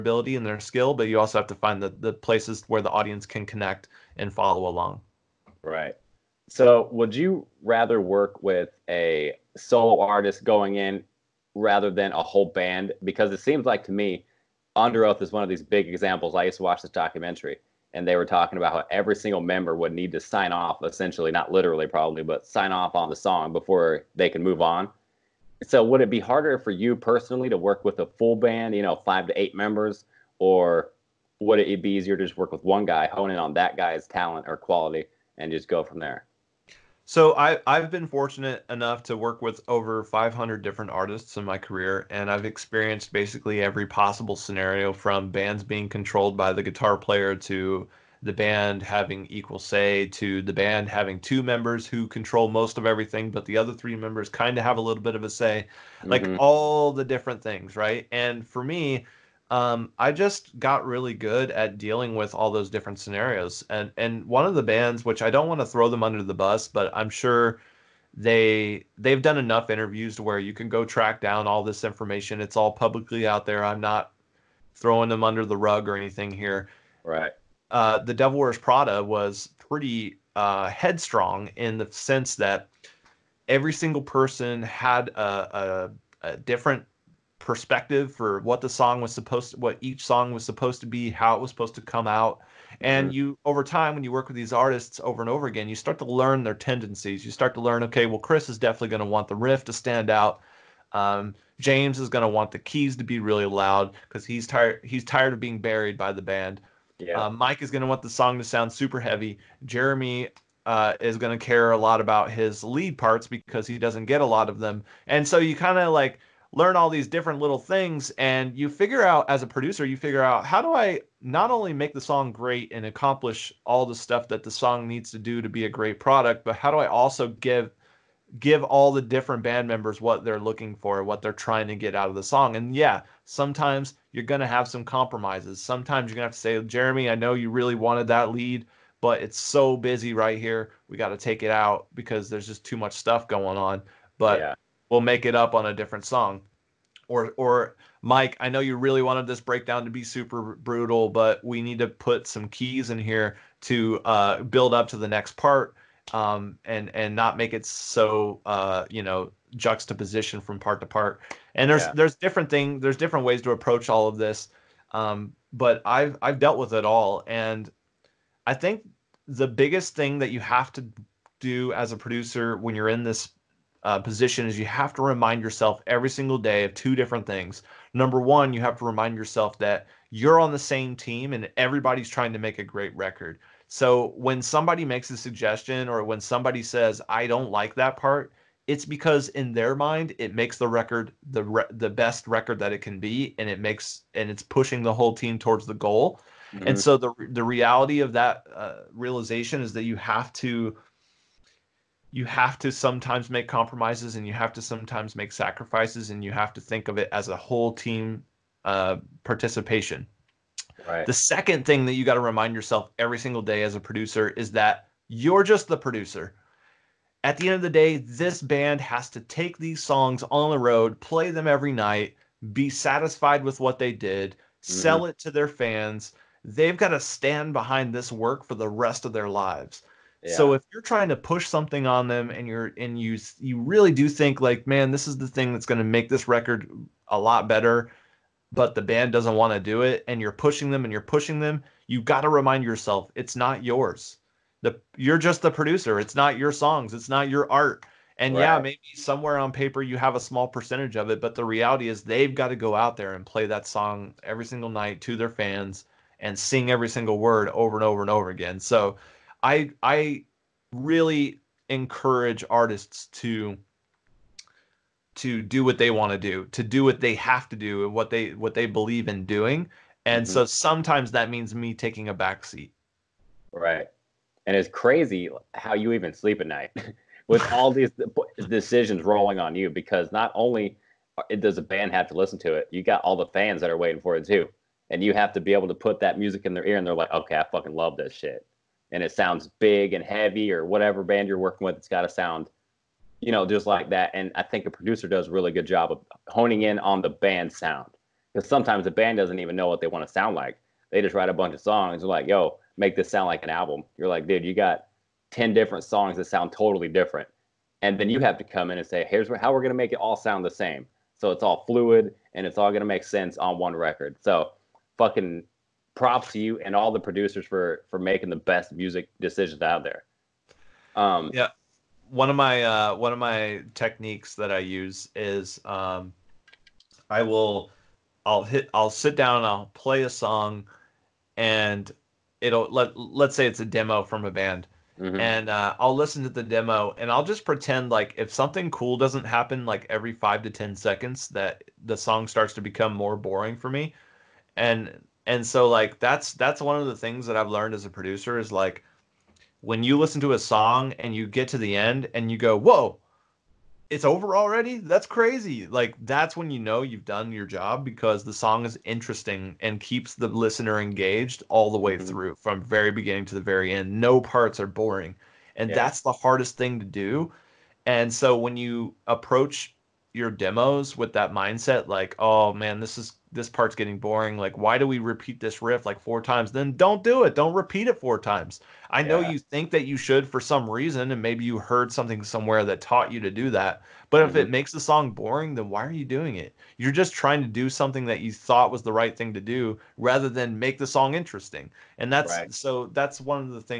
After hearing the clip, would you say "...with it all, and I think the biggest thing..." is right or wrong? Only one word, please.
right.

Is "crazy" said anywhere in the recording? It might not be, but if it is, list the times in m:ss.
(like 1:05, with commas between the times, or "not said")
4:34, 5:55.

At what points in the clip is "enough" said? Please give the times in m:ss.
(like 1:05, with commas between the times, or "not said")
0:38, 1:09.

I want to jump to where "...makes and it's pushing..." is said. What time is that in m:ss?
3:13.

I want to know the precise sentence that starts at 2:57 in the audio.
Number one, you have to remind yourself that you're on the same team and everybody's trying to make a great record.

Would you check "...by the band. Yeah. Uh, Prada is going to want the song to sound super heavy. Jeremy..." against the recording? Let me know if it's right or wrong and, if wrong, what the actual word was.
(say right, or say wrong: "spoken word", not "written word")
wrong: "Mike", not "Prada".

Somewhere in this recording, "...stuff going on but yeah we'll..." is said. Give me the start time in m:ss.
2:22.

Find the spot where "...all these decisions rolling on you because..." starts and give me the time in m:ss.
4:37.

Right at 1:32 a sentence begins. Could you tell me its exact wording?
And you, over time, when you work with these artists over and over again, you start to learn their tendencies.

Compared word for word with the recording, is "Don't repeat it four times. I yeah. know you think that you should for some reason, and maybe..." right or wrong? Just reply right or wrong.
right.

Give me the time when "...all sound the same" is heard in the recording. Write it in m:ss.
5:09.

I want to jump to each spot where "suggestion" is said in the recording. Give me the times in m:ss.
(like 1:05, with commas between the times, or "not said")
3:05.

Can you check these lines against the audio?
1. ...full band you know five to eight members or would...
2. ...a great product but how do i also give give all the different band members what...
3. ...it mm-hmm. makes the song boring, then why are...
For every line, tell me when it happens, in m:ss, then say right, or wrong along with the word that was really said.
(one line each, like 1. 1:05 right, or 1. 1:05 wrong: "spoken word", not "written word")
1. 0:28 right
2. 2:05 right
3. 6:24 right.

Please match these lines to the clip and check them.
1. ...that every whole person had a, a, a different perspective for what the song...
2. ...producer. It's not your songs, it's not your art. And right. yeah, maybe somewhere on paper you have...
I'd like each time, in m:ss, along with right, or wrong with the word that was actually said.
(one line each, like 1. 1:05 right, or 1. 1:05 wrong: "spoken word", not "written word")
1. 1:22 wrong: "single", not "whole"
2. 4:05 right.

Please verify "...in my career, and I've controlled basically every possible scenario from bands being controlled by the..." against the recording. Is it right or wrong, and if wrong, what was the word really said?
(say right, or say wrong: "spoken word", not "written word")
wrong: "experienced", not "controlled".